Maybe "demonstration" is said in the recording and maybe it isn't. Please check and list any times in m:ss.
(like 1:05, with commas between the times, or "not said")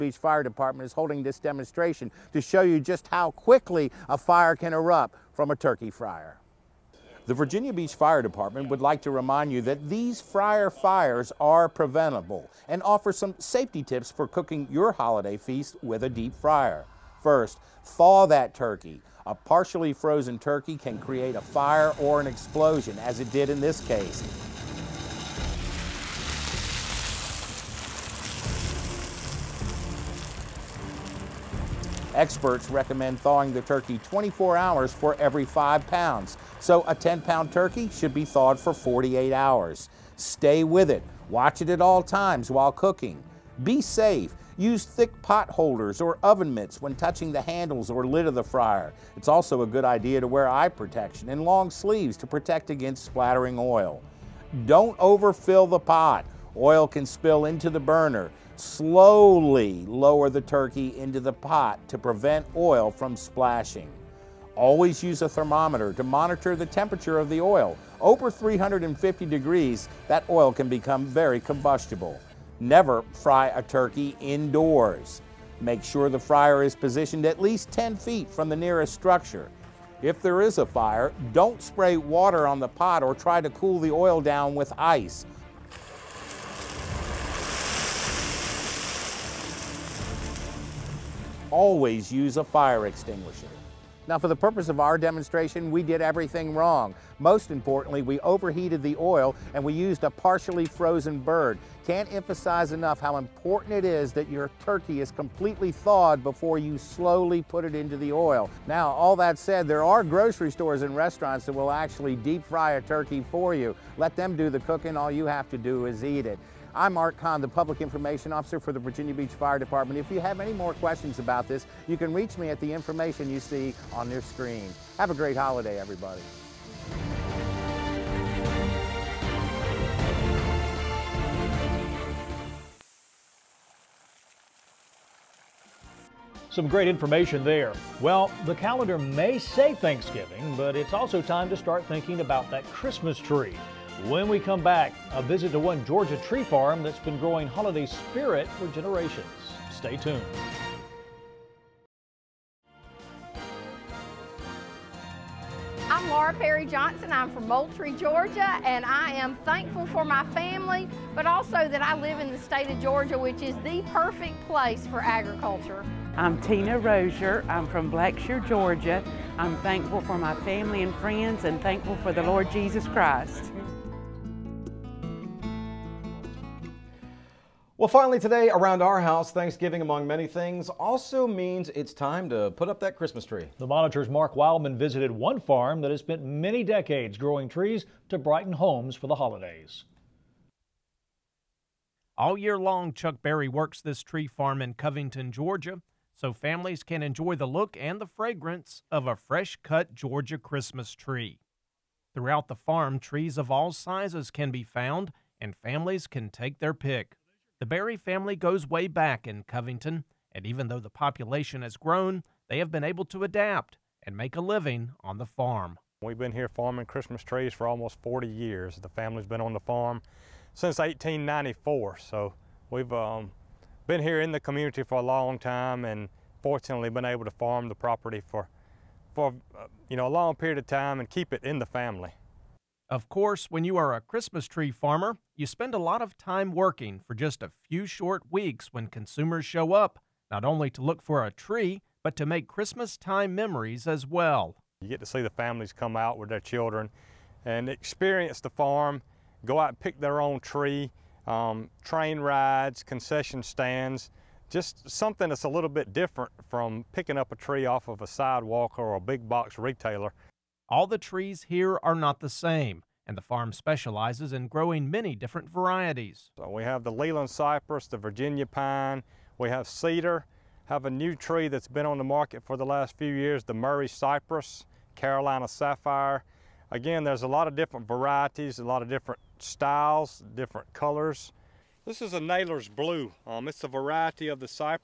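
0:01, 1:34.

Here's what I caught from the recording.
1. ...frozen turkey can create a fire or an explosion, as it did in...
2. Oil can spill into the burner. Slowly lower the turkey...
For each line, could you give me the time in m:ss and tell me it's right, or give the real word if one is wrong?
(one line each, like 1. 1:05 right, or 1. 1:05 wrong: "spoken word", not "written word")
1. 0:19 right
2. 0:56 right.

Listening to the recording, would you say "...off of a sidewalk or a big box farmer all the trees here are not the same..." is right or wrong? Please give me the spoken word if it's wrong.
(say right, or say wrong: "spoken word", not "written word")
wrong: "retailer", not "farmer".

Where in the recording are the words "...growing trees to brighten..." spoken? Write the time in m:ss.
3:07.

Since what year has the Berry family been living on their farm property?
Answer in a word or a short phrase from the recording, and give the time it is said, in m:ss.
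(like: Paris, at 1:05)
1894, at 3:40.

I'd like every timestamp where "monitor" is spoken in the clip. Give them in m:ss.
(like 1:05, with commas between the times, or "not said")
1:06, 3:03.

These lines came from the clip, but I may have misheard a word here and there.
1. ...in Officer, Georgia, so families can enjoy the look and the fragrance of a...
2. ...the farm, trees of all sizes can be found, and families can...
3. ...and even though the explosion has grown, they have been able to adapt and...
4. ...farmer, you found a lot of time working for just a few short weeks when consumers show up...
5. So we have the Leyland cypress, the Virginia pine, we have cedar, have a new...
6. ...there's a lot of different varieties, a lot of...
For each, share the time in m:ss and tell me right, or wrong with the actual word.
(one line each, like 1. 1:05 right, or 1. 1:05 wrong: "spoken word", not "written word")
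1. 3:14 wrong: "Covington", not "Officer"
2. 3:22 right
3. 3:30 wrong: "population", not "explosion"
4. 3:54 wrong: "spend", not "found"
5. 4:26 right
6. 4:37 right.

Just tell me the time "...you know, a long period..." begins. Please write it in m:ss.
3:49.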